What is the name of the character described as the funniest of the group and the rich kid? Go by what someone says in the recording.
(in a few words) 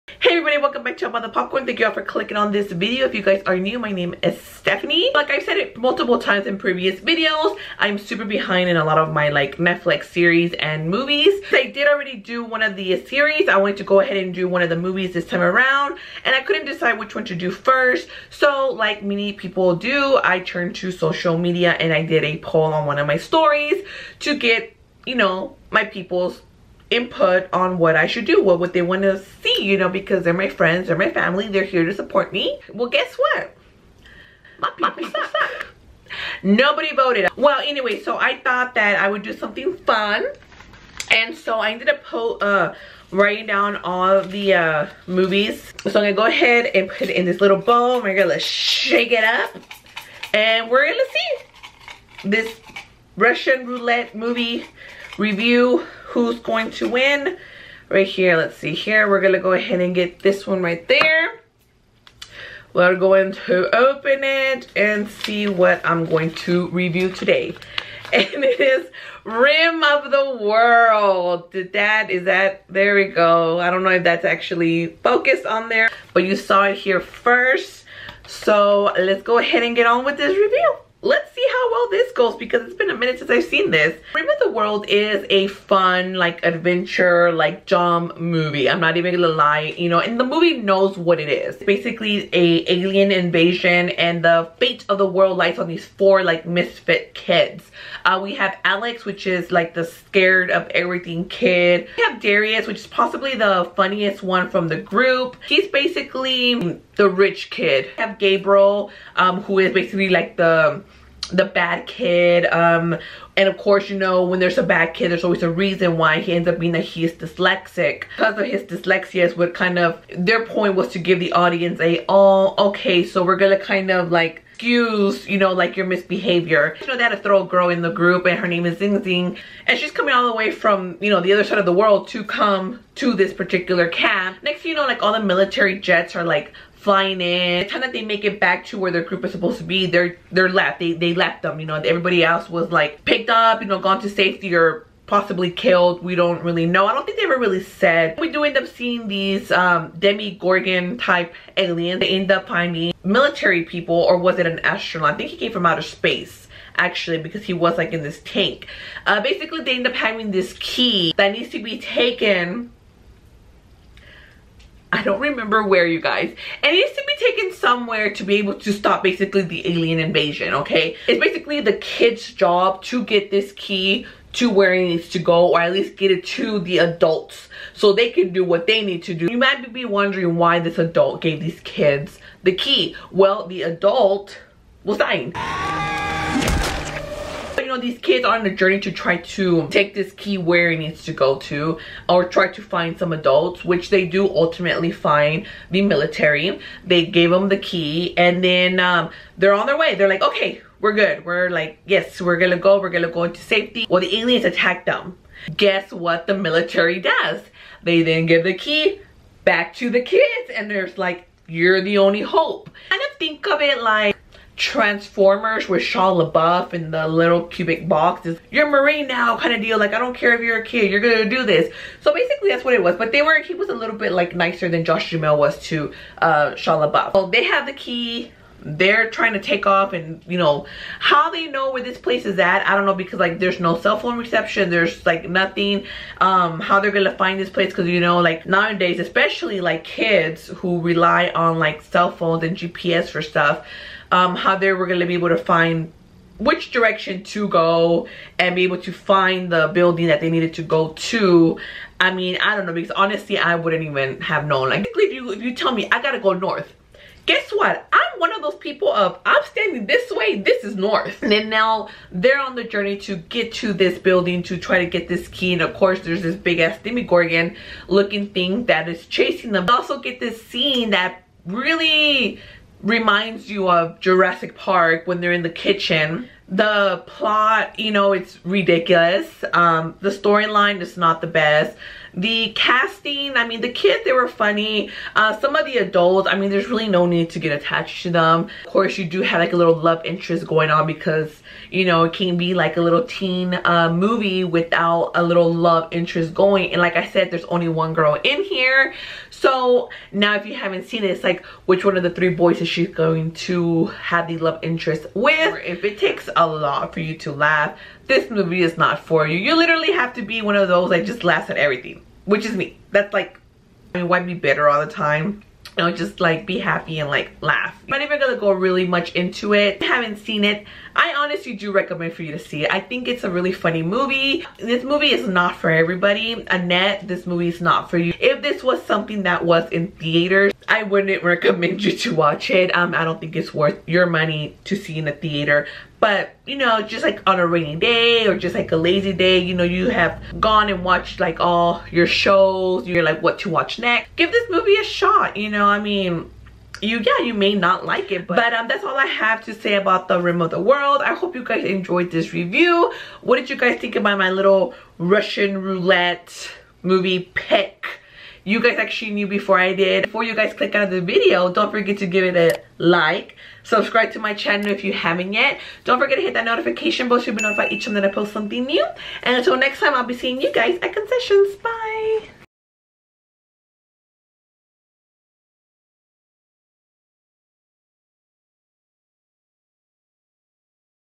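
Darius.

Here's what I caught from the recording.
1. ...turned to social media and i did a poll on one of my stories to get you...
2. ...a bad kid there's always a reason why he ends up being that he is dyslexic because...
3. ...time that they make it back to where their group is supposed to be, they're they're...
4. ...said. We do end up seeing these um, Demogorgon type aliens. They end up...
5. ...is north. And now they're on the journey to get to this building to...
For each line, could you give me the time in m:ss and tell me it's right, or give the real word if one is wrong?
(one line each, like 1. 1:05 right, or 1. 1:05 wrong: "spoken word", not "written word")
1. 0:20 right
2. 1:54 right
3. 2:17 right
4. 2:27 right
5. 4:20 right.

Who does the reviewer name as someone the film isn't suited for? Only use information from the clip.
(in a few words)
Annette.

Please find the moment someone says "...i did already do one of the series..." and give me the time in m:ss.
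0:11.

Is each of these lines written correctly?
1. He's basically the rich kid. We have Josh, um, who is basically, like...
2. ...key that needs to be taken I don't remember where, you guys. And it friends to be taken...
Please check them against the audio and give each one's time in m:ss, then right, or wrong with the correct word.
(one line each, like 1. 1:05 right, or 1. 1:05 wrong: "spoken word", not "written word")
1. 1:45 wrong: "Gabriel", not "Josh"
2. 2:40 wrong: "needs", not "friends".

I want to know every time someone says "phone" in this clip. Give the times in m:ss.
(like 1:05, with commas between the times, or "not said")
3:53, 4:02.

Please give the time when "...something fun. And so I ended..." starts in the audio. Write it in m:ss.
0:39.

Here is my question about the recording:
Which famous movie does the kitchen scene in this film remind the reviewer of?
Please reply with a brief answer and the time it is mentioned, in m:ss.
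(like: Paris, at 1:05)
Jurassic Park, at 4:33.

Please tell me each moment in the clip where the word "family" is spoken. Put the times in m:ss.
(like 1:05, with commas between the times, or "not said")
0:31.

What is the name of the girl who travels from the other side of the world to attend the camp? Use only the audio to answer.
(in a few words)
ZhenZhen.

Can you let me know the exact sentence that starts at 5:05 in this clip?
If it takes a lot for you to laugh, this movie is not for you.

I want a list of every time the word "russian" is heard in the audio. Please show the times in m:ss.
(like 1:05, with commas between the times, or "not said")
0:53, 5:54.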